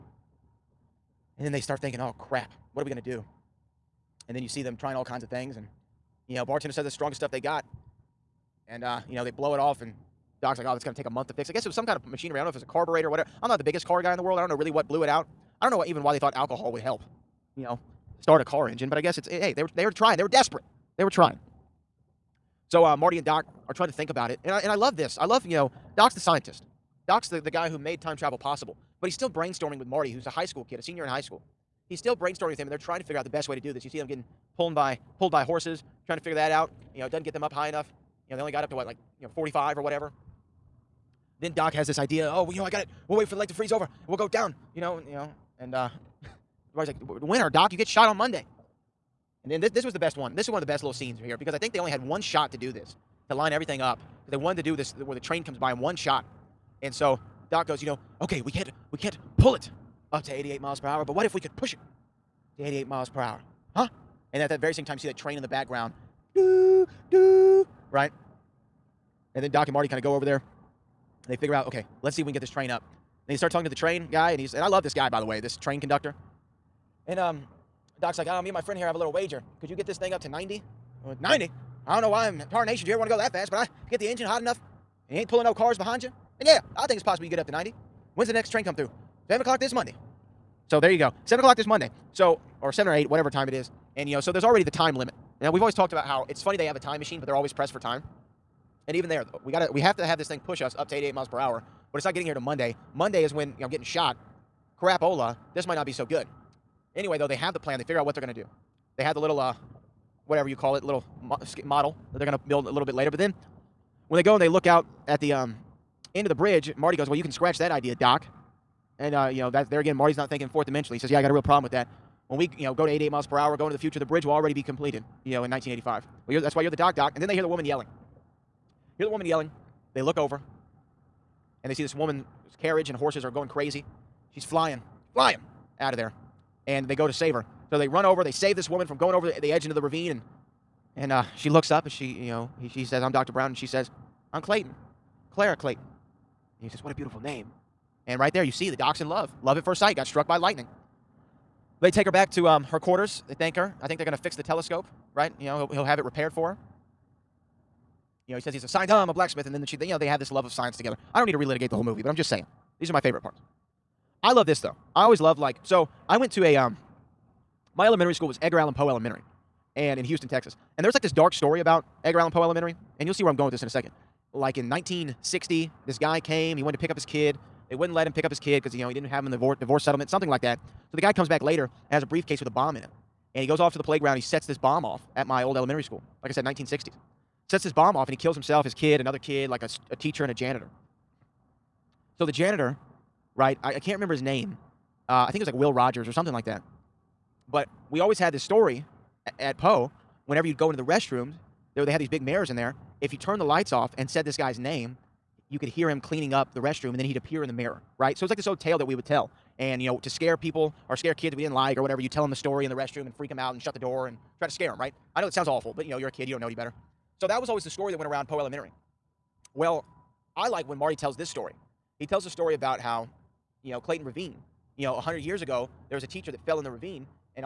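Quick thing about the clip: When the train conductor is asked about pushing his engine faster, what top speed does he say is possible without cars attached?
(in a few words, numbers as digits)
90.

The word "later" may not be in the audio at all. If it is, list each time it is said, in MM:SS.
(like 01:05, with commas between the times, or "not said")
01:52, 03:01.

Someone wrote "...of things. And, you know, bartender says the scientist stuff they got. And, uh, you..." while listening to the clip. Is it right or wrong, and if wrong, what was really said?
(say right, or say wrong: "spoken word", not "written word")
wrong: "strongest", not "scientist".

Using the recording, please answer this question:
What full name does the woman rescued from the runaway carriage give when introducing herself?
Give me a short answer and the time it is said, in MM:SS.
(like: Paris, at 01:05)
Clara Clayton, at 02:25.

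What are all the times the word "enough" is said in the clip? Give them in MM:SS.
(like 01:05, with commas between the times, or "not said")
00:37, 01:24.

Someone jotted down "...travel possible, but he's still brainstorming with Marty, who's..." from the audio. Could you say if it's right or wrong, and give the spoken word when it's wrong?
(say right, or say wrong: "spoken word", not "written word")
right.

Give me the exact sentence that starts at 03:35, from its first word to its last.
I know it sounds awful, but you know, you're a kid, you don't know any better.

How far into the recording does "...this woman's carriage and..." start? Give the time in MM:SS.
02:11.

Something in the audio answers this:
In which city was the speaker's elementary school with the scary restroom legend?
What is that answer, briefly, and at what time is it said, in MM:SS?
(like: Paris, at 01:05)
Houston, Texas, at 02:50.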